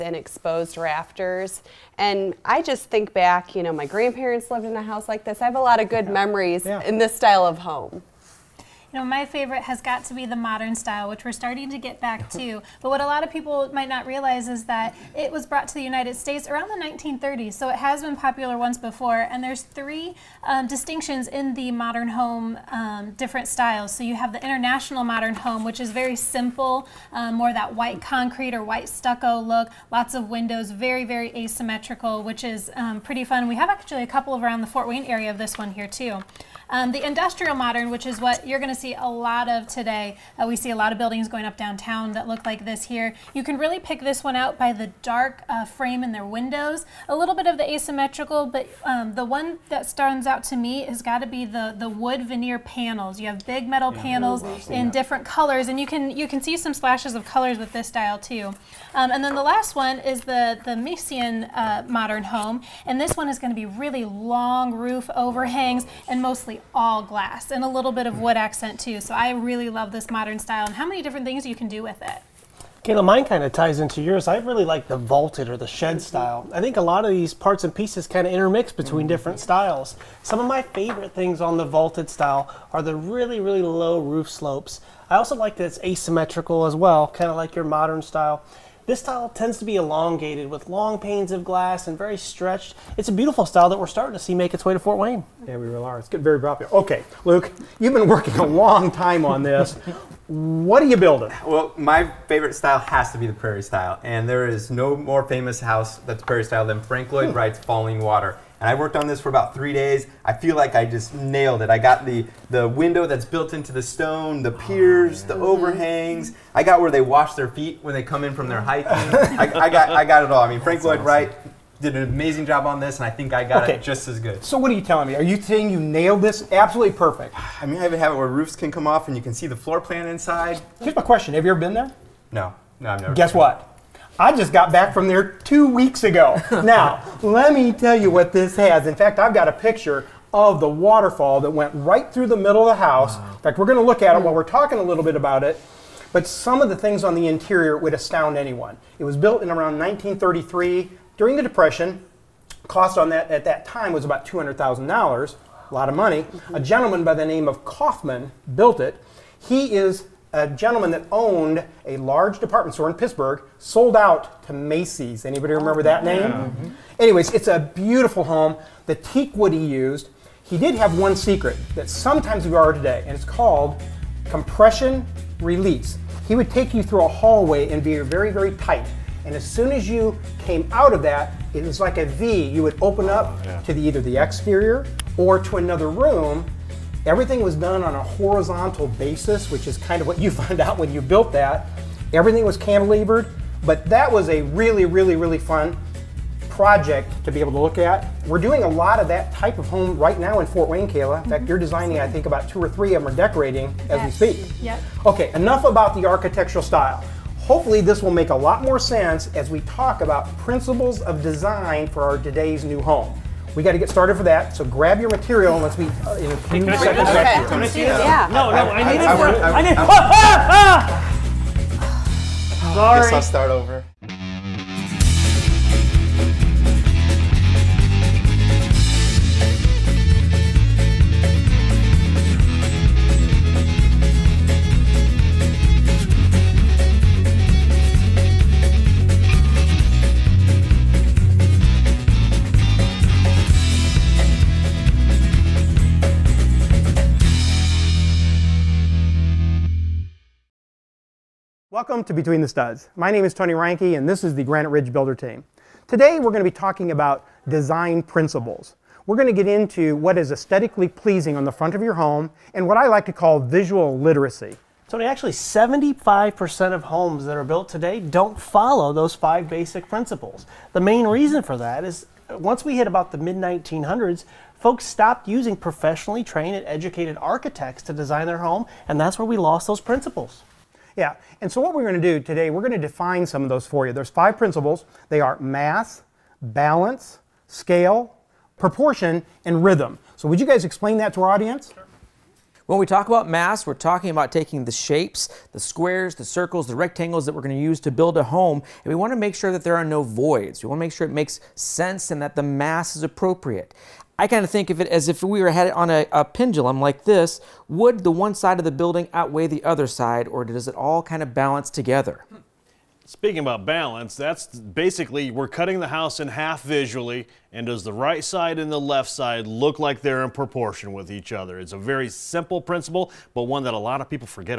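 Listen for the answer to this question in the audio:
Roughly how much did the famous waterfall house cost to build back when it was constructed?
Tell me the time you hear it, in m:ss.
2:34.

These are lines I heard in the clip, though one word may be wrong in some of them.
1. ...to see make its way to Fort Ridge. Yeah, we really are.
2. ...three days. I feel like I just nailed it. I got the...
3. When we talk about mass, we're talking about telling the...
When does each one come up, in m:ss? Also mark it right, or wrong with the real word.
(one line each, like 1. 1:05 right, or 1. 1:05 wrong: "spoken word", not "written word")
1. 1:34 wrong: "Wayne", not "Ridge"
2. 1:49 right
3. 4:52 wrong: "taking", not "telling".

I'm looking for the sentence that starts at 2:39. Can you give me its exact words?
He is a gentleman that owned a large department store in Pittsburgh sold out to Macy's.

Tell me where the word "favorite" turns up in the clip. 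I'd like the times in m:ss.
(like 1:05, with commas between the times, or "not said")
0:09, 1:20, 1:42.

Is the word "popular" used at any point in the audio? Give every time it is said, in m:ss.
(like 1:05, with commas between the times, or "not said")
0:18, 1:36.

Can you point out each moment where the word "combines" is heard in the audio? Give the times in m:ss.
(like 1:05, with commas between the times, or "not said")
not said.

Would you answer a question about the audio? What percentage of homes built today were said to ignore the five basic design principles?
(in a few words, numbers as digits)
75%.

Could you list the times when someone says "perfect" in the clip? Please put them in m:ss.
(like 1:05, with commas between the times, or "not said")
2:06.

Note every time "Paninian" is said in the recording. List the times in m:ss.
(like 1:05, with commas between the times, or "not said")
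not said.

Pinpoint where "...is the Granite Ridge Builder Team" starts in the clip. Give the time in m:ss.
4:14.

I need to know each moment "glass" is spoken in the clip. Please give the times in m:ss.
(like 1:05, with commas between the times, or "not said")
1:07, 1:31.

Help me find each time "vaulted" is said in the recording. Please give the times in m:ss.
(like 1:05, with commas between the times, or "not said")
1:14, 1:21.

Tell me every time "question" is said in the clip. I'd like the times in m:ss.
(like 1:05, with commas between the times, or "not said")
2:11.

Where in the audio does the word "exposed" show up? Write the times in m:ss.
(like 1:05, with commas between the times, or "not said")
0:00.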